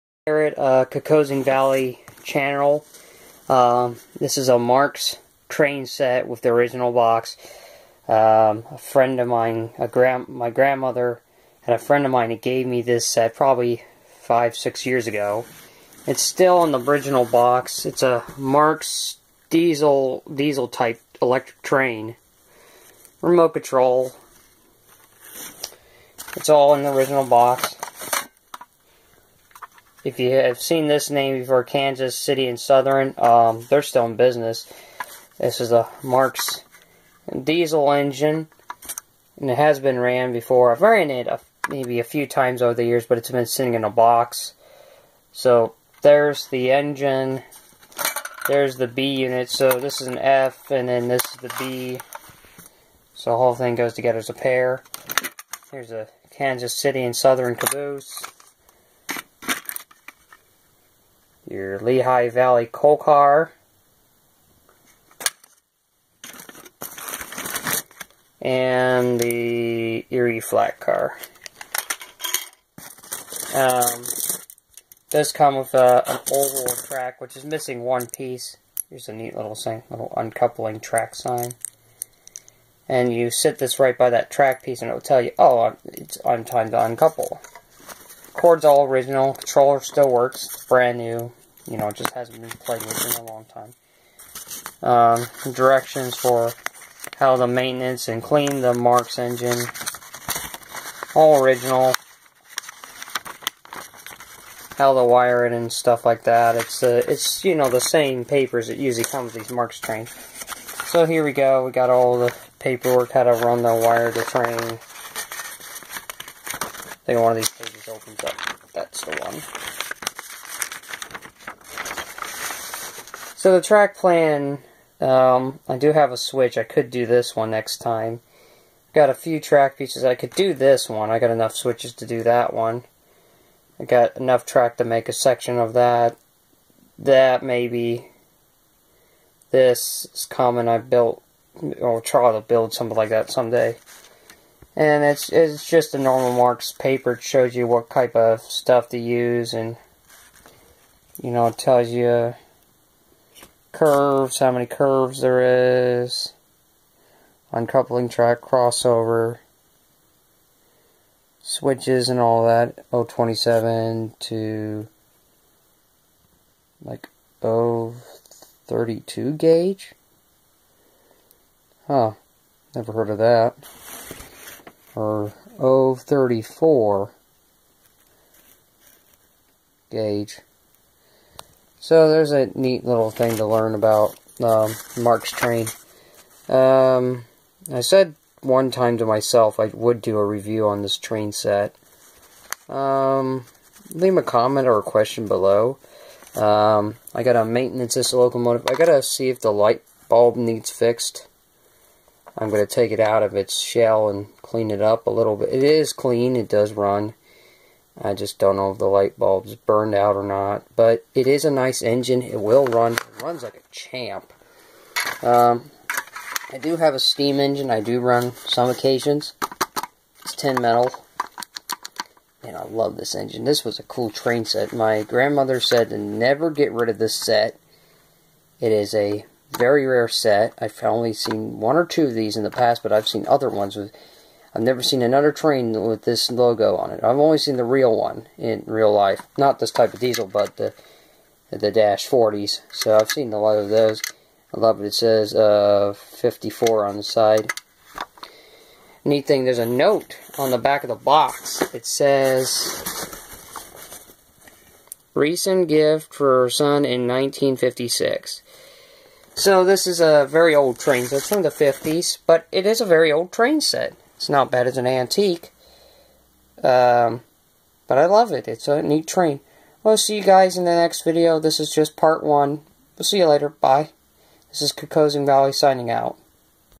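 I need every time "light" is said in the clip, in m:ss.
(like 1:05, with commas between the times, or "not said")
3:19, 3:28.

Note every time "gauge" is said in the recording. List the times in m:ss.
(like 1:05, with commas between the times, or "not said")
2:49, 2:59.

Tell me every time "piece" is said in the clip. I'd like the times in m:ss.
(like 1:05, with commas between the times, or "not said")
1:18, 1:24, 2:09.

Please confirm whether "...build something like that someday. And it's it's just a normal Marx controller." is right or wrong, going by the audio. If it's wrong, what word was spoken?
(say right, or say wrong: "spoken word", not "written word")
wrong: "paper", not "controller".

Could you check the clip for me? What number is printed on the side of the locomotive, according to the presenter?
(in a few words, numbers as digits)
54.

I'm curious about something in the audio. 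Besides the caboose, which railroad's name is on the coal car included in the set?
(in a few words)
Lehigh Valley.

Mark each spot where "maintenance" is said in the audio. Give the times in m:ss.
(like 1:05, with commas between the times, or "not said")
1:37, 3:17.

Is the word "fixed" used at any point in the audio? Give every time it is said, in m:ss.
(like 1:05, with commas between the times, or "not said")
3:20.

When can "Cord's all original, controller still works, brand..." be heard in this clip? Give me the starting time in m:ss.
1:28.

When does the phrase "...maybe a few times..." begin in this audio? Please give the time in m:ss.
0:41.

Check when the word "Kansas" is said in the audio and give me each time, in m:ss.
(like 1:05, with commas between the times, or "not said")
0:31, 0:56.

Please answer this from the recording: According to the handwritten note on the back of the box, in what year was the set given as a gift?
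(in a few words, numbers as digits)
1956.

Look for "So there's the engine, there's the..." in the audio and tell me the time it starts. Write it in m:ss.
0:45.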